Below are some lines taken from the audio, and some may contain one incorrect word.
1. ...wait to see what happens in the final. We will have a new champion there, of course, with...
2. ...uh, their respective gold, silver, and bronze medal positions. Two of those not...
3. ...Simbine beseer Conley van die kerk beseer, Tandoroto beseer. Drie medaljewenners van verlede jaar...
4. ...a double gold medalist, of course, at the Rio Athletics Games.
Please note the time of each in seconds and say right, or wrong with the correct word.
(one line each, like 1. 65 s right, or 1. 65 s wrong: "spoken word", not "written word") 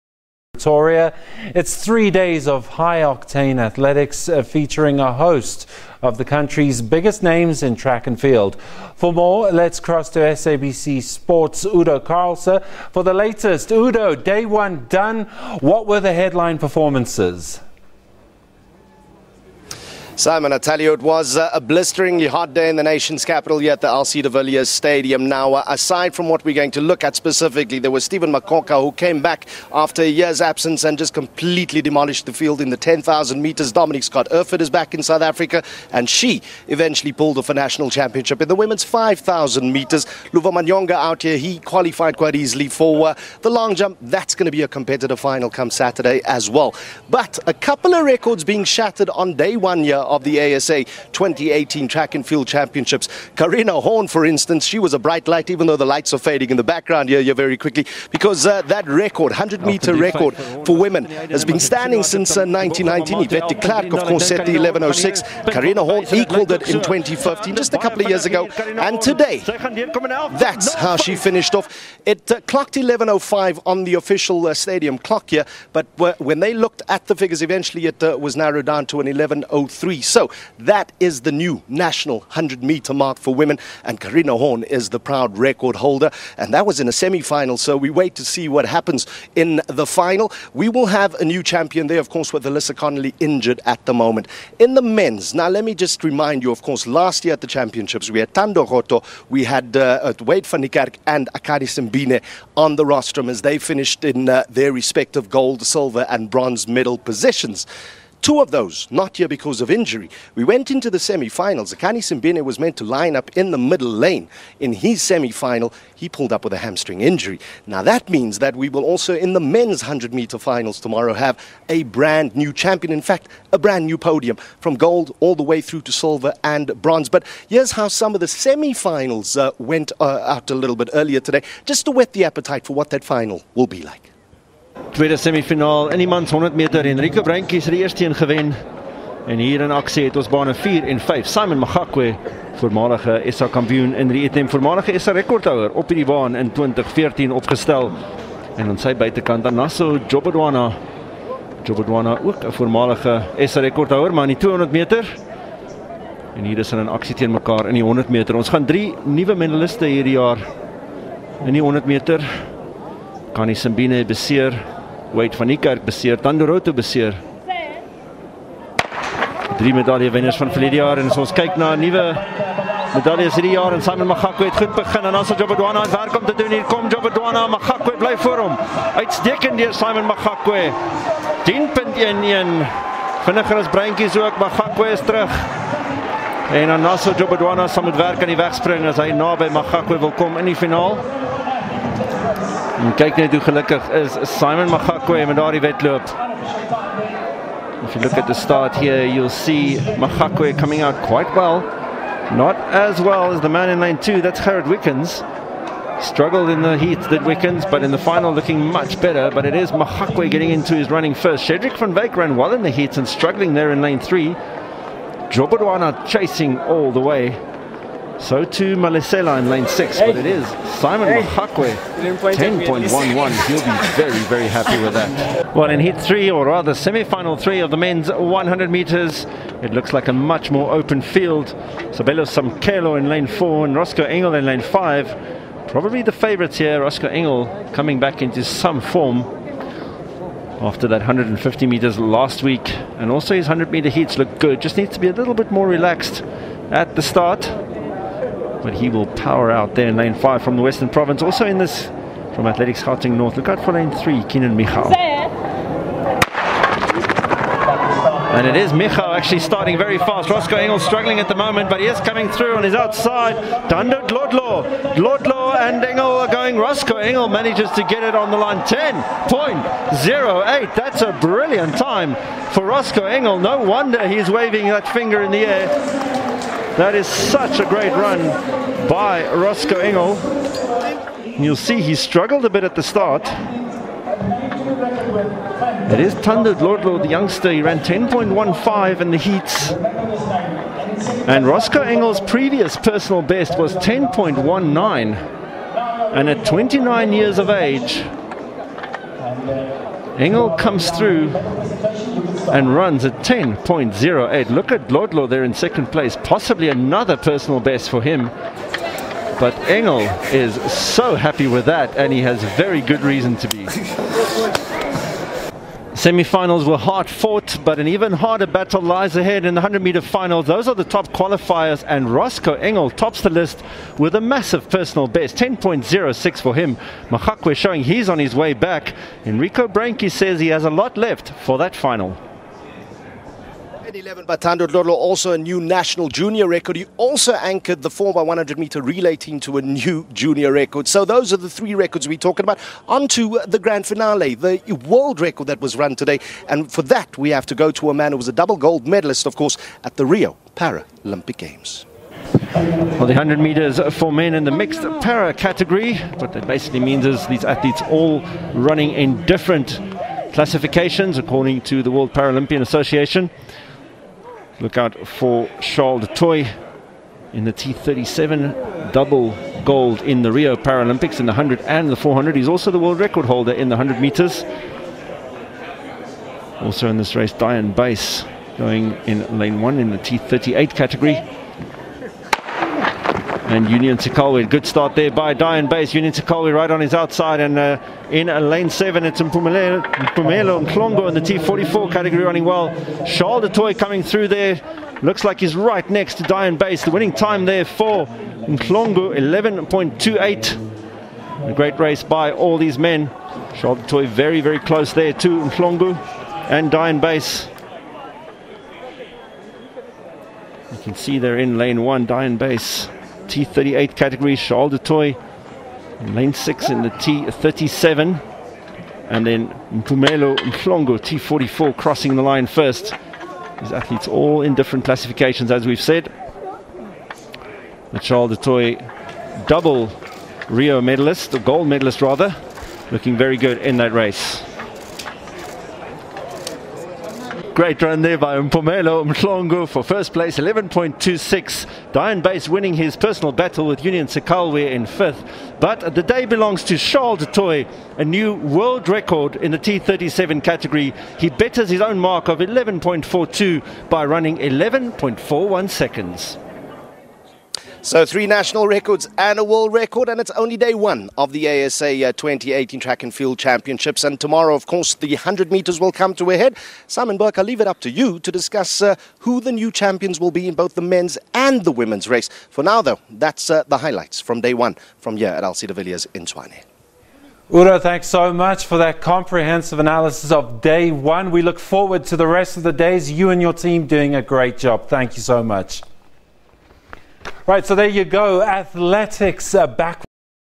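1. 87 s right
2. 104 s right
3. 163 s wrong: "Wade", not "Conley"
4. 348 s wrong: "Paralympic", not "Athletics".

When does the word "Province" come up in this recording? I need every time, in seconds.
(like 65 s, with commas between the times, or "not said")
250 s.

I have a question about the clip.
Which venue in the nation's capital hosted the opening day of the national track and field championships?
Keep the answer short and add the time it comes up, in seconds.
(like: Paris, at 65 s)
LC de Villiers Stadium, at 23 s.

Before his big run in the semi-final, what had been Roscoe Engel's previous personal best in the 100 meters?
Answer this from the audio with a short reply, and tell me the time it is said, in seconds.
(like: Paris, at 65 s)
10.19, at 293 s.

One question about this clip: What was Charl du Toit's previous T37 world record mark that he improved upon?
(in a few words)
11.42.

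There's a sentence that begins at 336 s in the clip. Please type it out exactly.
He also anchored the 4x100 meter relay team to a new junior record.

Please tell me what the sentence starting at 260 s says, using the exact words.
Roscoe Engel struggling at the moment, but he is coming through on his outside.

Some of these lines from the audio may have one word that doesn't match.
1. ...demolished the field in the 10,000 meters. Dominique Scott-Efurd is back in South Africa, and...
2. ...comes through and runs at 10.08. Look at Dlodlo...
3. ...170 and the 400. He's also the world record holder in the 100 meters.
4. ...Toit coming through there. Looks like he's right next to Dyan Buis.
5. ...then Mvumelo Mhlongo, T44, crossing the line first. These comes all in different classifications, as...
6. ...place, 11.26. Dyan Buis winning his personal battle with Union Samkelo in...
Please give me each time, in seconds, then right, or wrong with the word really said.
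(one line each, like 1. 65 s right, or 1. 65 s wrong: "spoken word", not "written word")
1. 31 s right
2. 300 s right
3. 371 s wrong: "100", not "170"
4. 393 s right
5. 419 s wrong: "athletes", not "comes"
6. 440 s wrong: "Sekailwe", not "Samkelo".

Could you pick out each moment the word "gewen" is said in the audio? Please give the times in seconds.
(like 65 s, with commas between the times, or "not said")
138 s.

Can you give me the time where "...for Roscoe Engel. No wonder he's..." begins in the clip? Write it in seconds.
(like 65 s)
272 s.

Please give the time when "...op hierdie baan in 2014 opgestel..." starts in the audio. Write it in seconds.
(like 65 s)
145 s.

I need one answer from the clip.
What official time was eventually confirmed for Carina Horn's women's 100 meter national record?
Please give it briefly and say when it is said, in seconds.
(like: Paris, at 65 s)
11.03, at 79 s.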